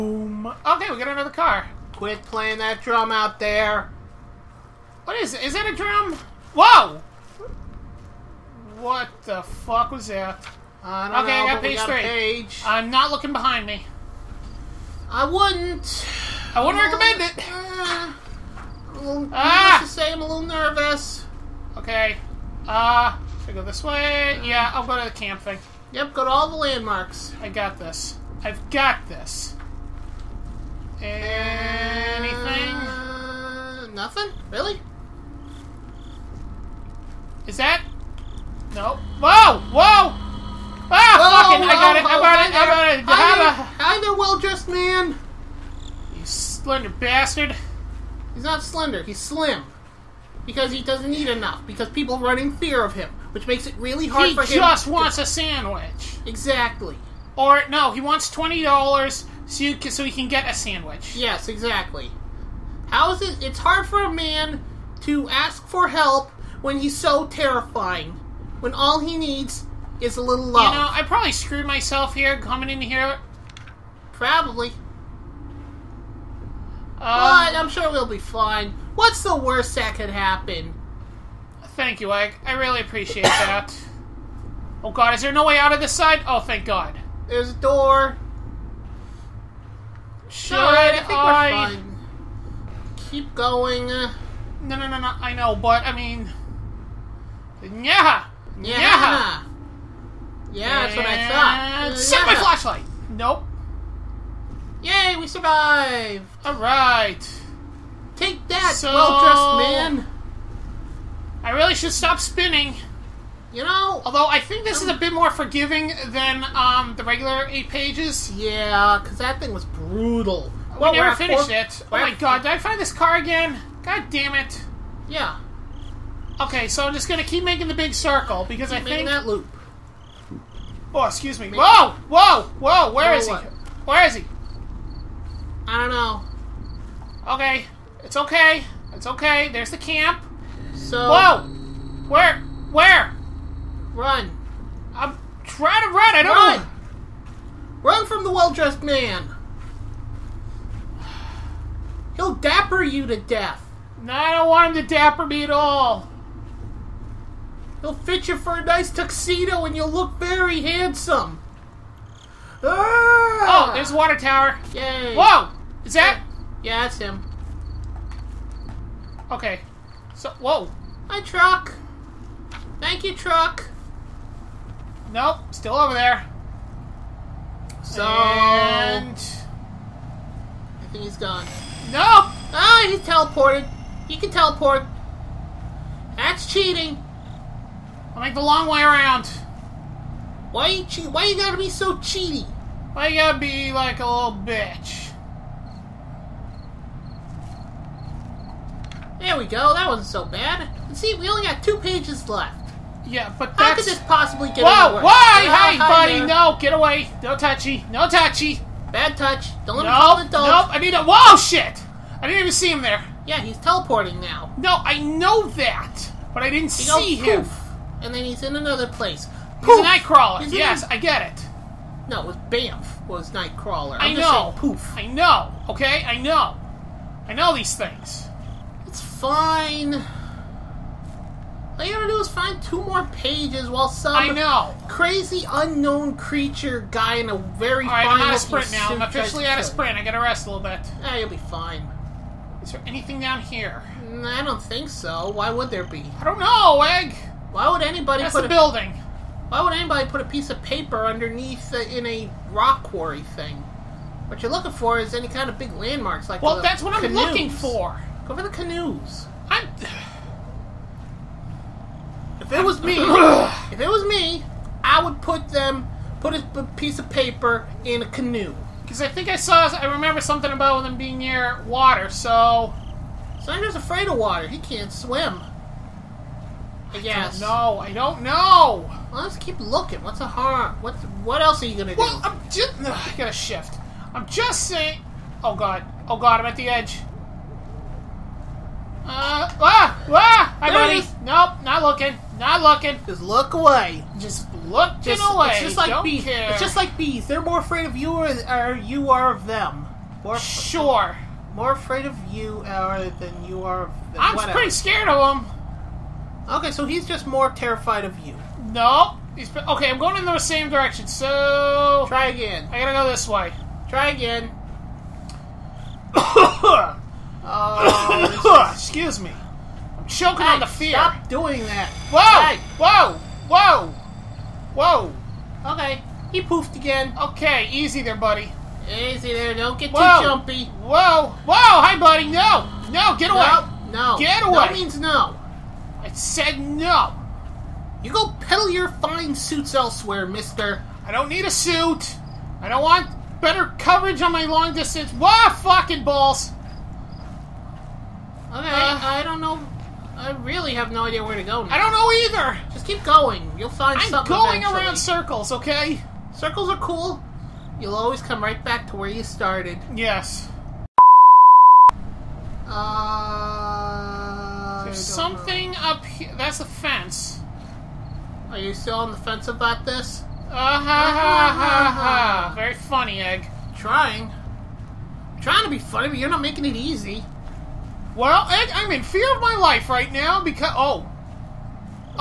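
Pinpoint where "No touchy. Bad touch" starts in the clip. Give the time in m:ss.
3:27.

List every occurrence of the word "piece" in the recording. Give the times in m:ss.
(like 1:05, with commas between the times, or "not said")
4:10, 4:26.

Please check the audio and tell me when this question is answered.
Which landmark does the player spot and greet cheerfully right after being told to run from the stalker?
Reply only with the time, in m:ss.
2:43.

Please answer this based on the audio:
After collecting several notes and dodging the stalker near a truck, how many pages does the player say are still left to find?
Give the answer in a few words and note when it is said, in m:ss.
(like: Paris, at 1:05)
2, at 3:21.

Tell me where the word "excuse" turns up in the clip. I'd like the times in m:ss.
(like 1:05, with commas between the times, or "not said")
2:11, 5:18.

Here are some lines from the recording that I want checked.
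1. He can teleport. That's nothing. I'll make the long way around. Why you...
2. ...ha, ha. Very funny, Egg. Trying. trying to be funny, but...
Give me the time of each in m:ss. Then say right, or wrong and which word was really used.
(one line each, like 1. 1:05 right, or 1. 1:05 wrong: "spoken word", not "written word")
1. 3:04 wrong: "cheating", not "nothing"
2. 6:11 right.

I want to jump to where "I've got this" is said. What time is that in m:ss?
0:28.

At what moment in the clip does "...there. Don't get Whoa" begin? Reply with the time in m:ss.
5:29.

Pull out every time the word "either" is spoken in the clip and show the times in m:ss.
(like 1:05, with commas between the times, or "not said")
5:52.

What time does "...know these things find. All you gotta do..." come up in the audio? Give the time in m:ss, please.
3:47.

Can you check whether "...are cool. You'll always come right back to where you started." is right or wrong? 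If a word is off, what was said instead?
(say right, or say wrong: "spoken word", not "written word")
right.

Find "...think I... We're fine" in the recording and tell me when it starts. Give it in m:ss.
1:30.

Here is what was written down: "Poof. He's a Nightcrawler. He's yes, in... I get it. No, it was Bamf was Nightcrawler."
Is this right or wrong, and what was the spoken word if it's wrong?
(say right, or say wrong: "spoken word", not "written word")
right.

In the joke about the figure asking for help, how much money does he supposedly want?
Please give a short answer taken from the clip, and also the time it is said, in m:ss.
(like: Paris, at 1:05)
20 dollars, at 0:57.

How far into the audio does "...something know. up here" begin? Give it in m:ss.
6:04.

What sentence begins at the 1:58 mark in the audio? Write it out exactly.
Yeah, because that thing was brutal.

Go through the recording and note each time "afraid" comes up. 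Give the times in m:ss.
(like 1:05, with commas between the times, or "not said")
4:33, 4:57, 5:01.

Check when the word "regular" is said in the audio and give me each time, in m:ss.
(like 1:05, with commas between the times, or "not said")
1:57.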